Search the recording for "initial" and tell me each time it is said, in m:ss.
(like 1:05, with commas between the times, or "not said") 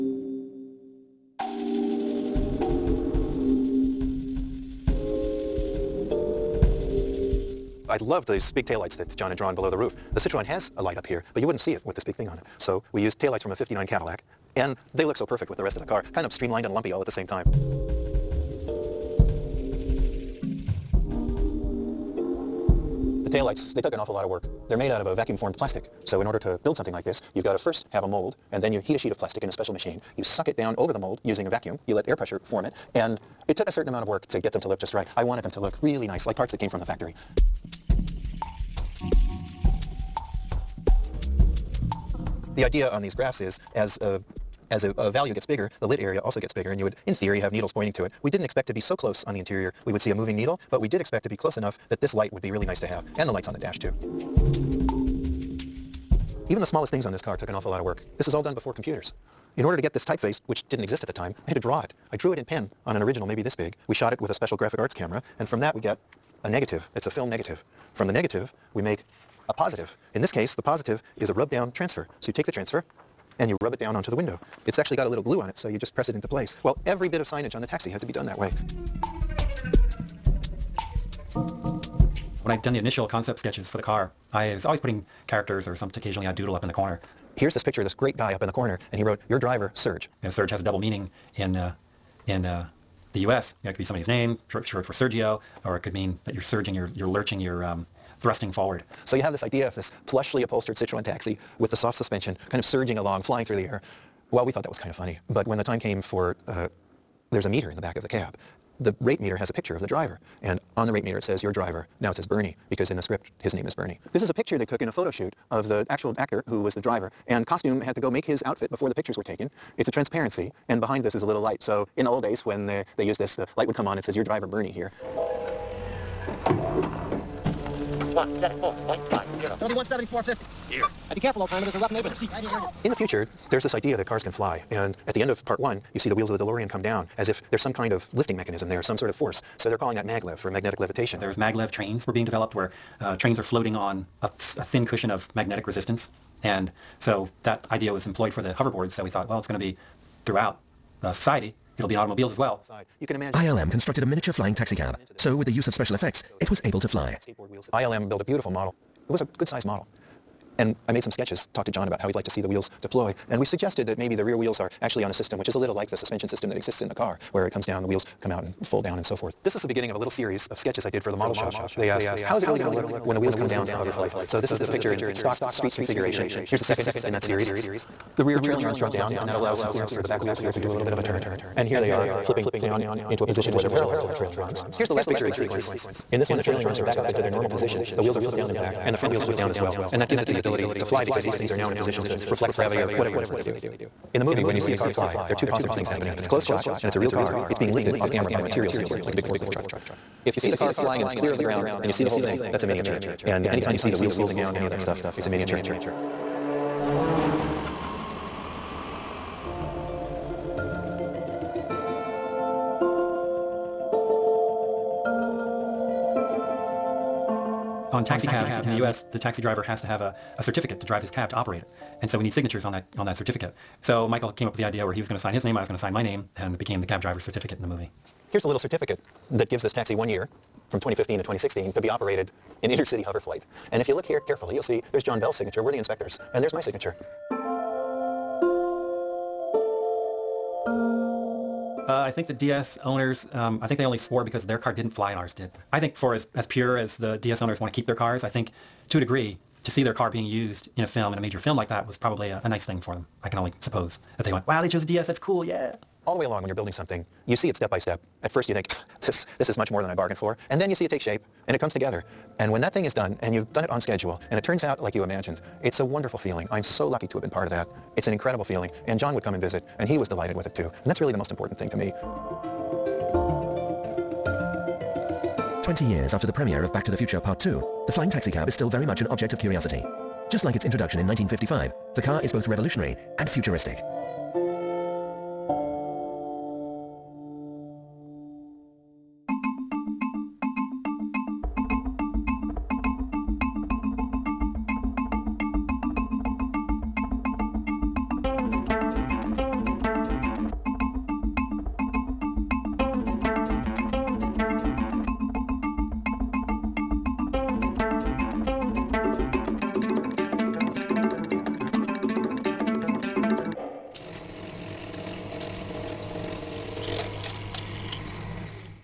1:22.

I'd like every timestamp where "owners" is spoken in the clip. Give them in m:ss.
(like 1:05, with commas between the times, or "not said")
4:02, 4:07.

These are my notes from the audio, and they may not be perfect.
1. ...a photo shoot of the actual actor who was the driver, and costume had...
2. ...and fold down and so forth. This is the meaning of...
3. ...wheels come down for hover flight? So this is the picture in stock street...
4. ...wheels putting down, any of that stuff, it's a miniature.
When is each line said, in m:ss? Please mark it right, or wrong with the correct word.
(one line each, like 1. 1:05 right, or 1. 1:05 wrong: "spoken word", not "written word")
1. 1:54 right
2. 2:48 wrong: "beginning", not "meaning"
3. 2:53 right
4. 3:23 wrong: "folding", not "putting".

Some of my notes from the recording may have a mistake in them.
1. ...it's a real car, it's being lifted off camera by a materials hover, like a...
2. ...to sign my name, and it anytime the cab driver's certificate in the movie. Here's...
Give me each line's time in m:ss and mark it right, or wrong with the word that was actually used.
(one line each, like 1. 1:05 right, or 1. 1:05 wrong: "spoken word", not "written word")
1. 3:16 wrong: "handler", not "hover"
2. 3:45 wrong: "became", not "anytime".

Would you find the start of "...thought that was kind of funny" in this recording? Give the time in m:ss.
1:44.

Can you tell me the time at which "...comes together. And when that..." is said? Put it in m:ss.
4:21.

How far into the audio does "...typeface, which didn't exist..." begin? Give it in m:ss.
1:00.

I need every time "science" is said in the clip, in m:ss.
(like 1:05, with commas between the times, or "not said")
not said.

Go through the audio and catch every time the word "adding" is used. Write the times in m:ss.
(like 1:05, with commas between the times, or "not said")
not said.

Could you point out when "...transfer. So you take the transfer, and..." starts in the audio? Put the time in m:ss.
1:11.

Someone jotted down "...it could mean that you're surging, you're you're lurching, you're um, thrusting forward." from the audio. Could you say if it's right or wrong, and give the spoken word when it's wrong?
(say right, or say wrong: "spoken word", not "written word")
right.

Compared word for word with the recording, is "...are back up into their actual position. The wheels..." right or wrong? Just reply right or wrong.
wrong.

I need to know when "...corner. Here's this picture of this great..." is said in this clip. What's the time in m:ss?
1:26.